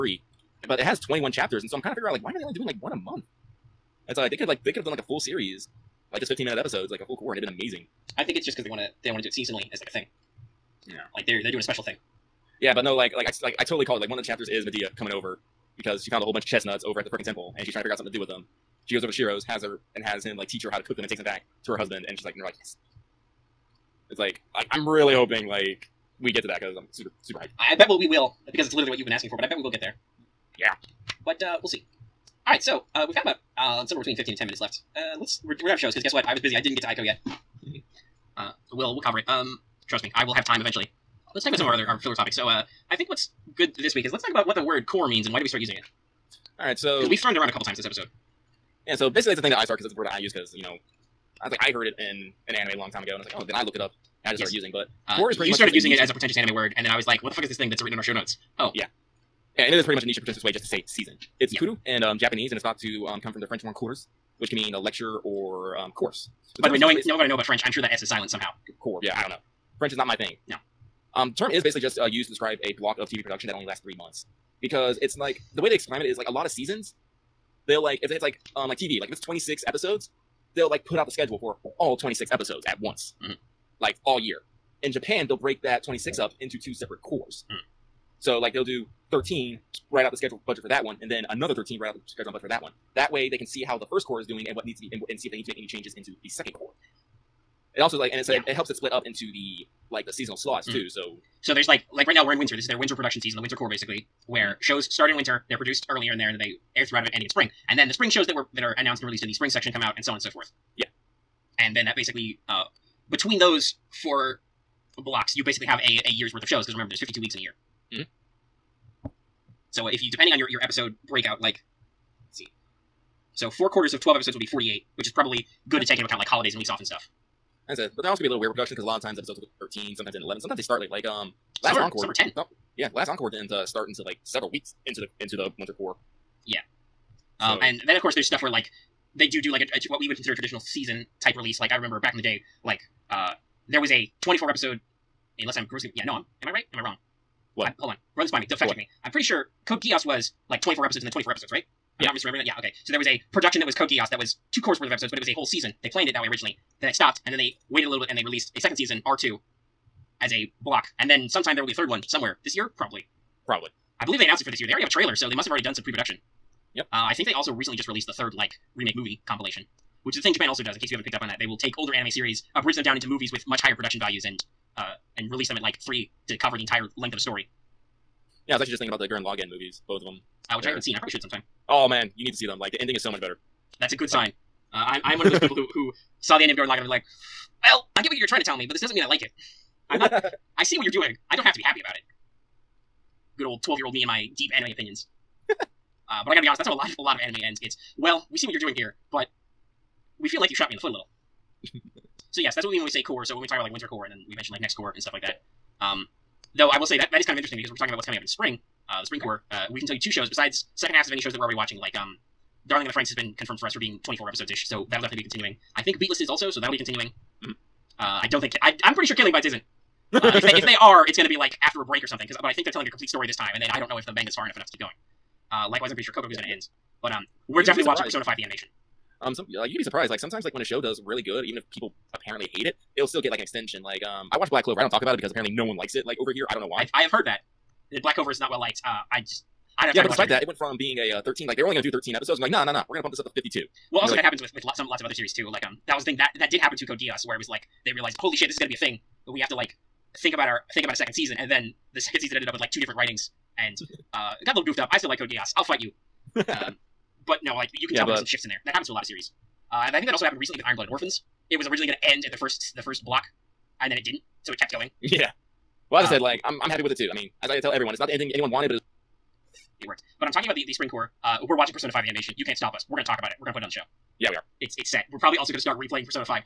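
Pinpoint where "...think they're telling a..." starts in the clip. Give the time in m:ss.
3:42.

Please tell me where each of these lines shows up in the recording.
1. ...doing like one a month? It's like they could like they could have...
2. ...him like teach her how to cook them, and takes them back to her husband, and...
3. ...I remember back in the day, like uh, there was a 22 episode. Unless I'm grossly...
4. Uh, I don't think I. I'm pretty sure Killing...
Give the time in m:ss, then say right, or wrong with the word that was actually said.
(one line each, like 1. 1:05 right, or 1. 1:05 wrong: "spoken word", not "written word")
1. 0:02 right
2. 0:20 right
3. 2:21 wrong: "24", not "22"
4. 3:37 right.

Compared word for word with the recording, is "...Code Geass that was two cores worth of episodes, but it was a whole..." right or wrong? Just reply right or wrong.
right.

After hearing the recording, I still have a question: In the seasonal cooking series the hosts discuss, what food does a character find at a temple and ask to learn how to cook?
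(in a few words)
Chestnuts.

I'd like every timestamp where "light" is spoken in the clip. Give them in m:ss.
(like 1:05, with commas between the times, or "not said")
not said.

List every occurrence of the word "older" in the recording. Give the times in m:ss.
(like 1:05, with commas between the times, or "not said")
2:51.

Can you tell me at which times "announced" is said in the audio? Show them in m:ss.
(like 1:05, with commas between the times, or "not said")
1:48, 2:44.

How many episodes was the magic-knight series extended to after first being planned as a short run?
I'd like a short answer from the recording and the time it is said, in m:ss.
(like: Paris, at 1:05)
52, at 4:03.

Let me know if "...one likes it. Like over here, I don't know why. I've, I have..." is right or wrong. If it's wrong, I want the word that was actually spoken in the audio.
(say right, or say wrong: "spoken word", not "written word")
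right.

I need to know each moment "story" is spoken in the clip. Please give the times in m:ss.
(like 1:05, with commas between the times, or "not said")
2:57, 3:43.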